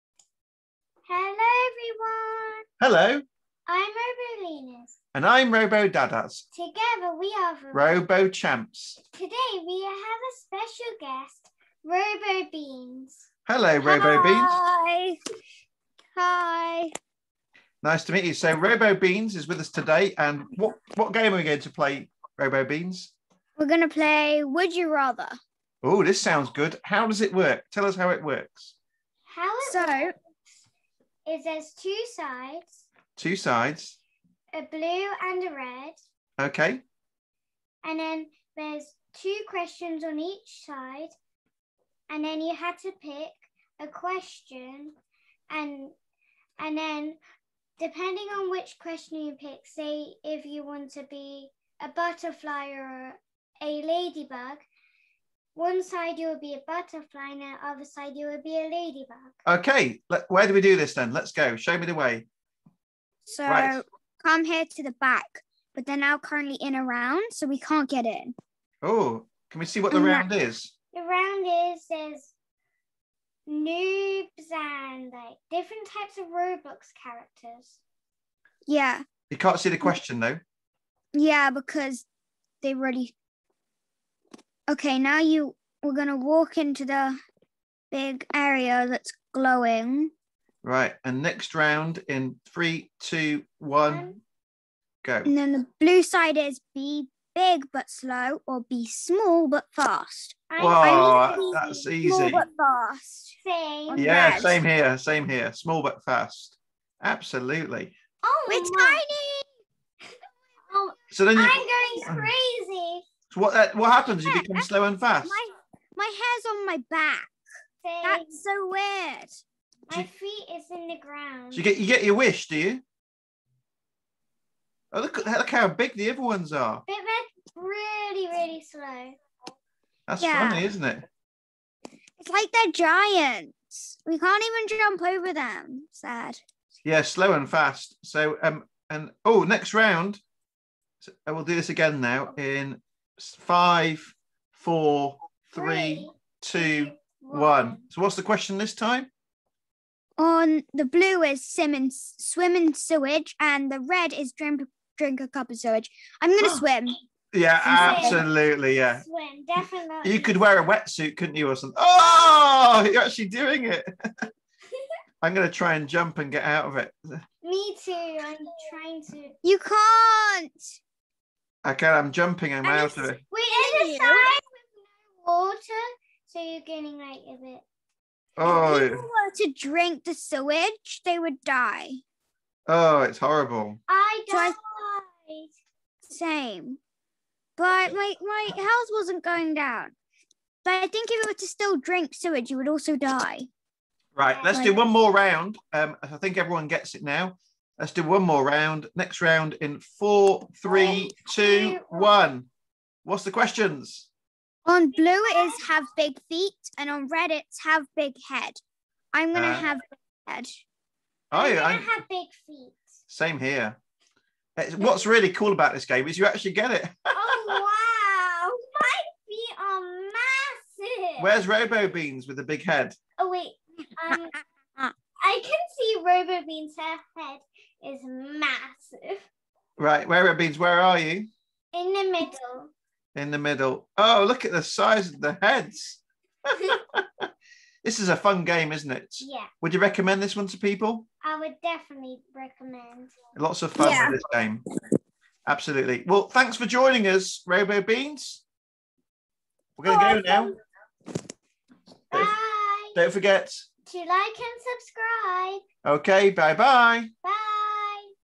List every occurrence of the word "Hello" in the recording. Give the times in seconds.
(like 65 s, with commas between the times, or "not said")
2 s, 13 s.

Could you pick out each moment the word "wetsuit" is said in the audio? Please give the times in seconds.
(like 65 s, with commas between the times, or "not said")
160 s.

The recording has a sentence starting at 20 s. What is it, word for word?
And what, what game are we going to play, Robo Beans?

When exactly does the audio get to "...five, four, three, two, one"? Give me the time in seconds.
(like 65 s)
143 s.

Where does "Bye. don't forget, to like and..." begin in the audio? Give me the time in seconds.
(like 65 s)
252 s.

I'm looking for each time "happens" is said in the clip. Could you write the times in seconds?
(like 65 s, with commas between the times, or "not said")
113 s.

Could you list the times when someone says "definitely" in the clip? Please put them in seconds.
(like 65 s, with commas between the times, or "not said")
159 s, 241 s.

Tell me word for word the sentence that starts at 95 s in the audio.
And then the blue side is be big but slow, or be small but fast.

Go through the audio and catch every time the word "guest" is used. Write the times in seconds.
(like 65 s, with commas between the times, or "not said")
10 s.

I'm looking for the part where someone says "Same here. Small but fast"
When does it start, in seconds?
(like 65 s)
104 s.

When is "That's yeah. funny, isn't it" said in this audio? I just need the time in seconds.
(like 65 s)
130 s.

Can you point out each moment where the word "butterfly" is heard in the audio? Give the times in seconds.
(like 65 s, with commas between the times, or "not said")
51 s, 56 s.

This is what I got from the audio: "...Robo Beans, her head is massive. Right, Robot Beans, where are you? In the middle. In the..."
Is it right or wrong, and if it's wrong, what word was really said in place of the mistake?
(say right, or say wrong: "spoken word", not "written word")
right.